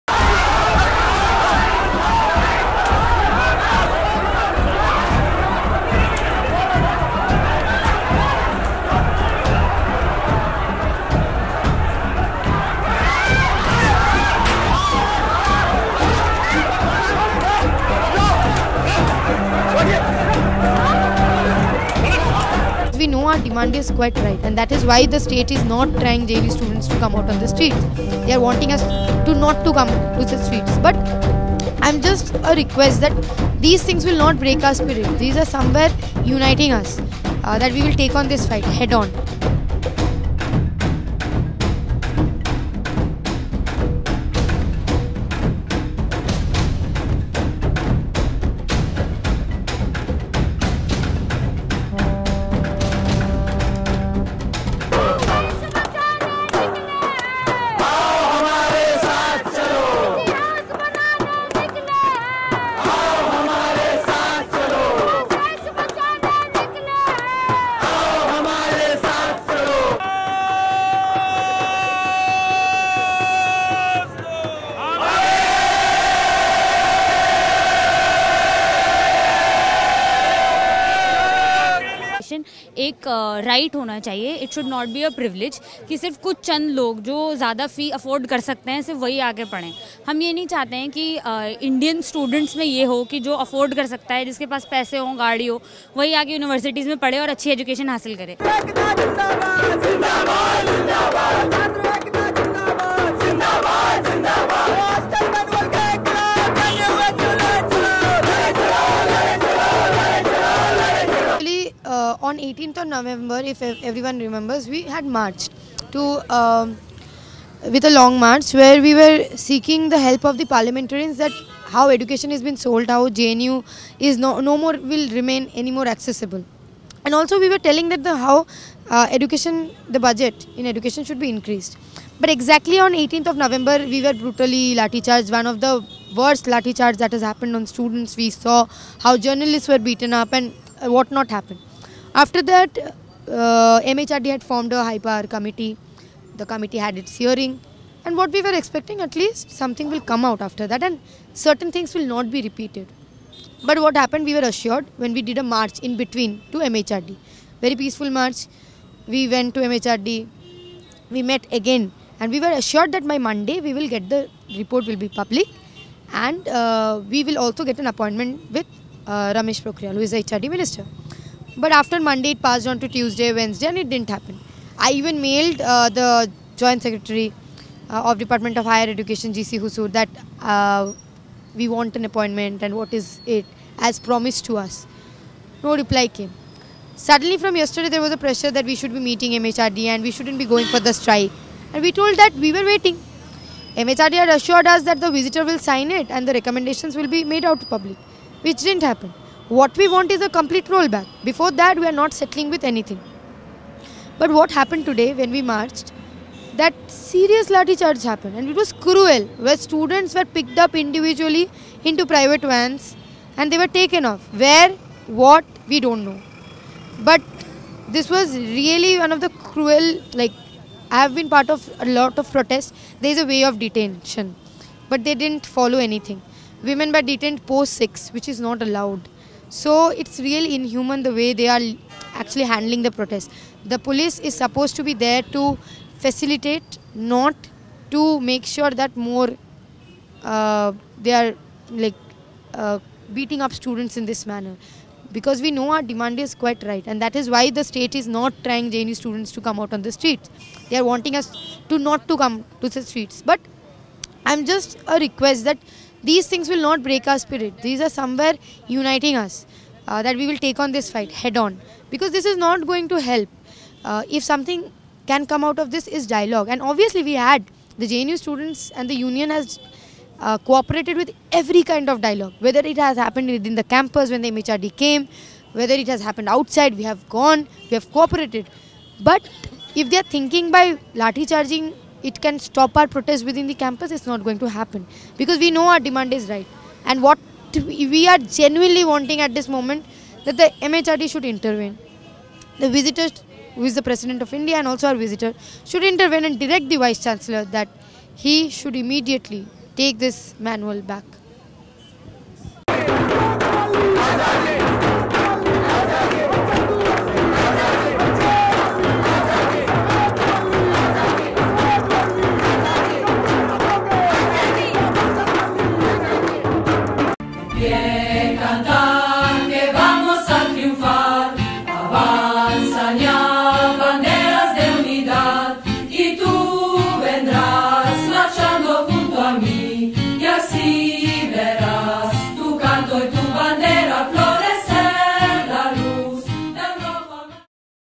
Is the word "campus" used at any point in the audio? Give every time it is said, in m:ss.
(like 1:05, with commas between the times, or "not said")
4:33, 4:43.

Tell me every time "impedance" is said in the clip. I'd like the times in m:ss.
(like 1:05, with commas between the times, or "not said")
not said.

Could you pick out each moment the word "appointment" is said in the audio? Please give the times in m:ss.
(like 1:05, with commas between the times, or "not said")
2:47, 3:02.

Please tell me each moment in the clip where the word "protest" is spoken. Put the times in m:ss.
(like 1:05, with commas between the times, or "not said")
3:42, 3:52, 4:42.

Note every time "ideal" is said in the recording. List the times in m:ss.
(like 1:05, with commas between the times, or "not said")
not said.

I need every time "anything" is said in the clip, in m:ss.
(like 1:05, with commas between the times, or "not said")
3:22, 3:45.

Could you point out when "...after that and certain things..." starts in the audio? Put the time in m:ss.
2:30.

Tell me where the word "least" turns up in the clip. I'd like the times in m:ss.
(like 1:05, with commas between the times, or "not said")
2:29.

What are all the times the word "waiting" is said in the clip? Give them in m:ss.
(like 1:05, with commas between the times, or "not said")
3:12.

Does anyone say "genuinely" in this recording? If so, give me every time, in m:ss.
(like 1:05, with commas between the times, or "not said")
4:48.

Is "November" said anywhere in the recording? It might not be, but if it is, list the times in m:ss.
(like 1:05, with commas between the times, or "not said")
1:52, 2:13.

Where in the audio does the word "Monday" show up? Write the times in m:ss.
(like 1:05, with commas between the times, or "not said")
2:43, 2:51.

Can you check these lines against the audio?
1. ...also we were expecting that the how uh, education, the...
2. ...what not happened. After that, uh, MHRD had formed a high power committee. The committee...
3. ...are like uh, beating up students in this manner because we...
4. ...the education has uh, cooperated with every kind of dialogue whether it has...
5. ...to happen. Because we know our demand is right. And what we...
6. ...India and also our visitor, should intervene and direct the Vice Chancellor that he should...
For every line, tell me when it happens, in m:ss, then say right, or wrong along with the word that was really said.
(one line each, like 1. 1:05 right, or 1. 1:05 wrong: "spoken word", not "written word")
1. 2:07 wrong: "telling", not "expecting"
2. 2:20 right
3. 4:01 right
4. 4:28 wrong: "union", not "education"
5. 4:44 right
6. 4:54 right.